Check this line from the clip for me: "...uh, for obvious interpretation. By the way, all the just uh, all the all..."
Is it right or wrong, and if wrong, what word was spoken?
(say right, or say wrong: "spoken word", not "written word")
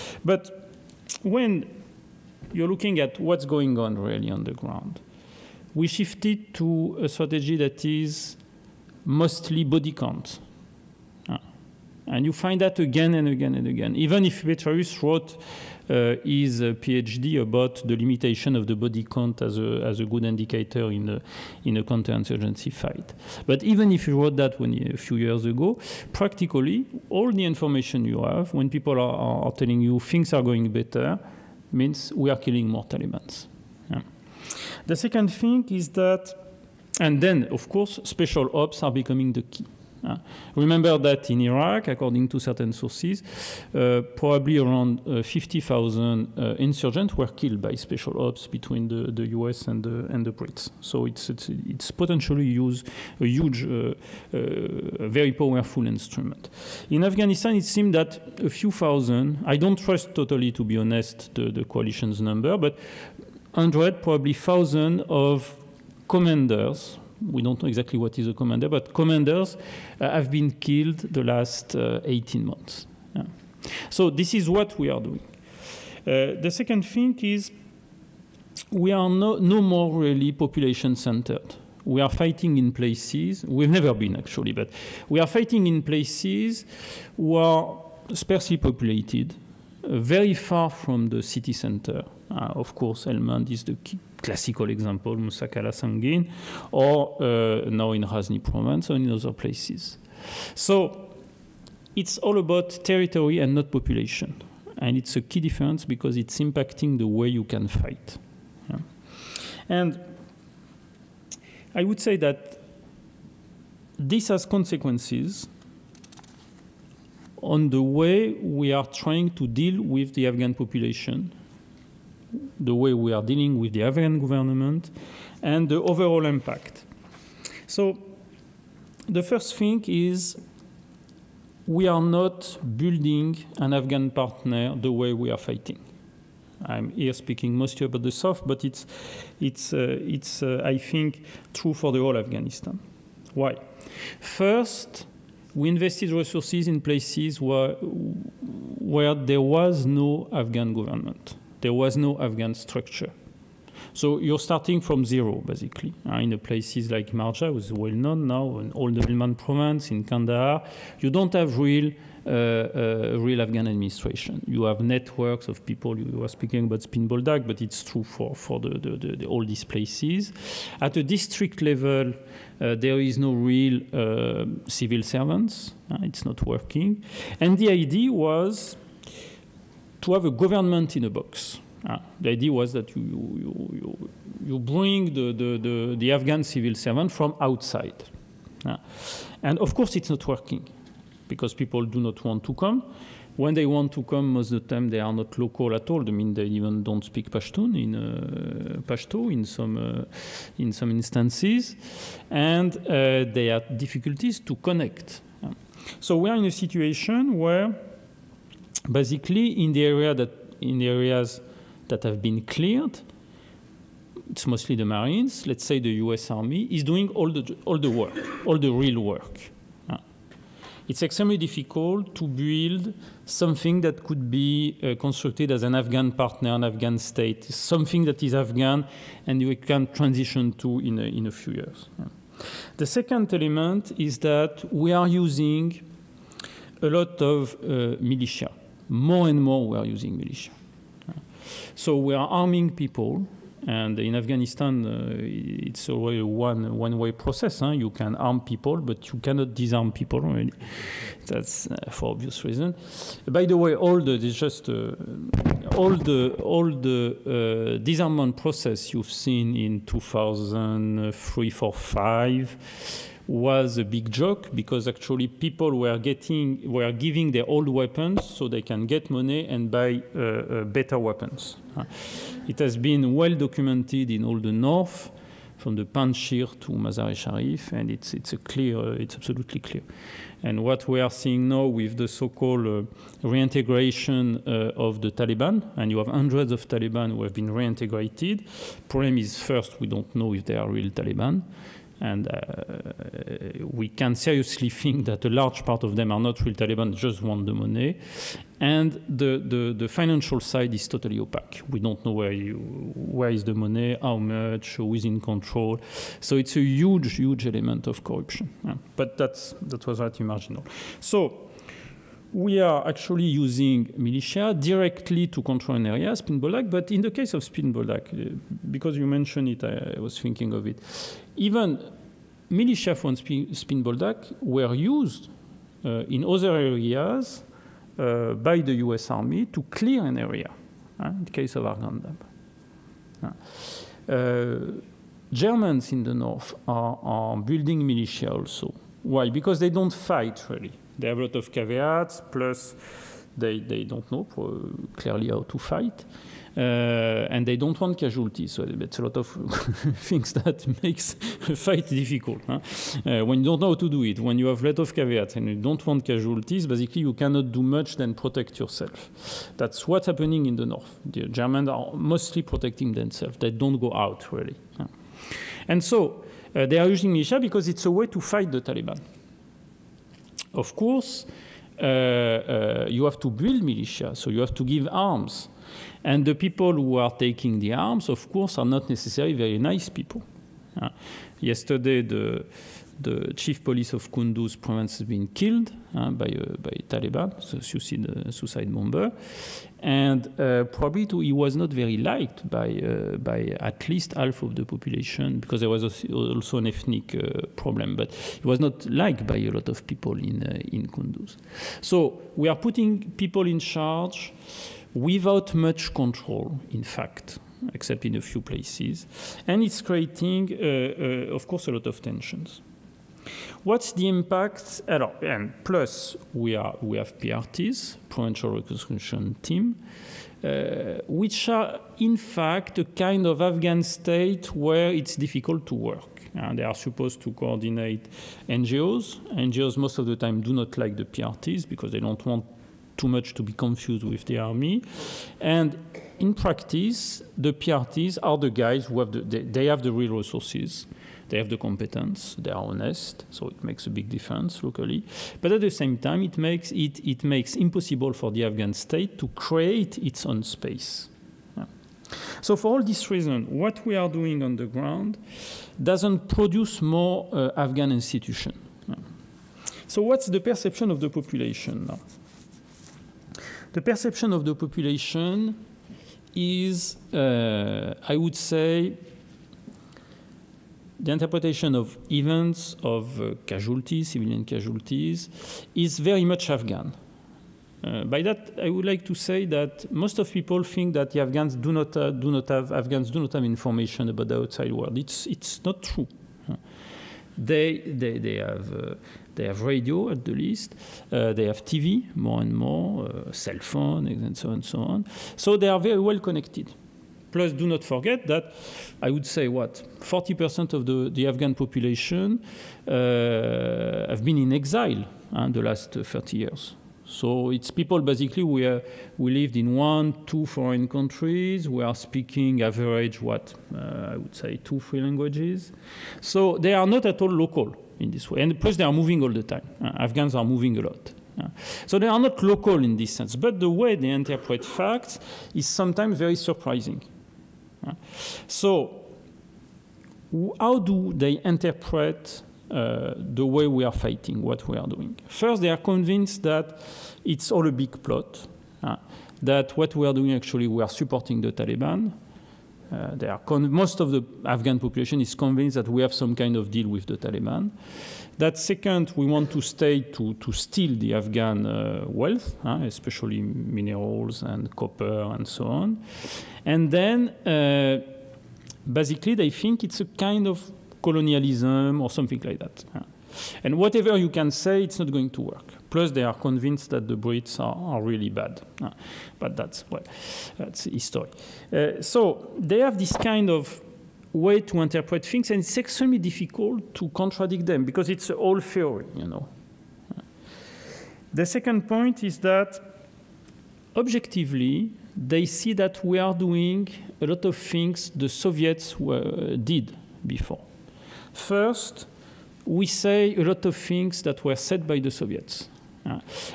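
wrong: "reason", not "interpretation".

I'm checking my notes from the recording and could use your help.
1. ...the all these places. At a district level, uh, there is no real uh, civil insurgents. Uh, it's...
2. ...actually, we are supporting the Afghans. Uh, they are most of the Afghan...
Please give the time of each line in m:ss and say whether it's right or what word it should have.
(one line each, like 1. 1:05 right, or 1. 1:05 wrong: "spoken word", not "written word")
1. 2:49 wrong: "servants", not "insurgents"
2. 9:00 wrong: "Taliban", not "Afghans".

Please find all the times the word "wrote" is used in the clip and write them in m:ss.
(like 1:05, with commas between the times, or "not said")
0:15, 0:24.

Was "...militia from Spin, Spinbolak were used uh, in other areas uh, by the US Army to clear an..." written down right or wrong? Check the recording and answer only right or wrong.
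right.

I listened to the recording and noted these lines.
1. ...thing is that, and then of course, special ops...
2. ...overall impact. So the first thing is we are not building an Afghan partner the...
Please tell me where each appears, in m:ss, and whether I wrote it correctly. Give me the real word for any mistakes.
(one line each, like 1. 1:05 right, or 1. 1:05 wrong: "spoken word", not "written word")
1. 0:35 right
2. 2:05 right.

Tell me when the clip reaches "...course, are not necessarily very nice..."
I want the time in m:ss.
6:18.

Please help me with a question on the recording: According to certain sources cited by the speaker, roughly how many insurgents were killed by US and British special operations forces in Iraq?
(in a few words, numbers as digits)
50,000.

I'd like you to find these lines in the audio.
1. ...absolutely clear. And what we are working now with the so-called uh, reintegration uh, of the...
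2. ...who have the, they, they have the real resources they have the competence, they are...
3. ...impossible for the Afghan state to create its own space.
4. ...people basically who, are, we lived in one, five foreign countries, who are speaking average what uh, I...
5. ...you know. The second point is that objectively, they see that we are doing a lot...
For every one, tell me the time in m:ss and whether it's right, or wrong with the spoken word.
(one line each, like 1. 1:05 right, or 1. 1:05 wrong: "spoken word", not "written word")
1. 4:39 wrong: "seeing", not "working"
2. 7:18 right
3. 7:27 right
4. 8:27 wrong: "two", not "five"
5. 9:39 right.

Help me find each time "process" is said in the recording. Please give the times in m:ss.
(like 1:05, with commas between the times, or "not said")
4:07, 4:18.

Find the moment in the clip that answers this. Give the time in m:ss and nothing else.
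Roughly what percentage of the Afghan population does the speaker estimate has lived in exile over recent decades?
8:20.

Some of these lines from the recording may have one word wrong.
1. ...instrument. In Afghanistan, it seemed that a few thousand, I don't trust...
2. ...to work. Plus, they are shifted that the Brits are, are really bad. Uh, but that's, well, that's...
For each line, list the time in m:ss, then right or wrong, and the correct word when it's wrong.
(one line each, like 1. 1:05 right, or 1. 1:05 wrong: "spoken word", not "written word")
1. 0:55 right
2. 9:25 wrong: "convinced", not "shifted".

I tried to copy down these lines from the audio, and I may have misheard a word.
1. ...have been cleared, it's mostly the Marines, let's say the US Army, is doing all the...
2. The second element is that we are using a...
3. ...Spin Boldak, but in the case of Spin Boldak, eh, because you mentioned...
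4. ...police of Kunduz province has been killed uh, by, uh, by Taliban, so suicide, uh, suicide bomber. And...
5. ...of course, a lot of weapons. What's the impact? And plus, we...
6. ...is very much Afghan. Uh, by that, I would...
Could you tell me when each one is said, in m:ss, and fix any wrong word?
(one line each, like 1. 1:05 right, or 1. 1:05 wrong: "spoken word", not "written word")
1. 3:32 right
2. 3:52 right
3. 5:16 right
4. 6:23 right
5. 6:51 wrong: "tensions", not "weapons"
6. 7:55 right.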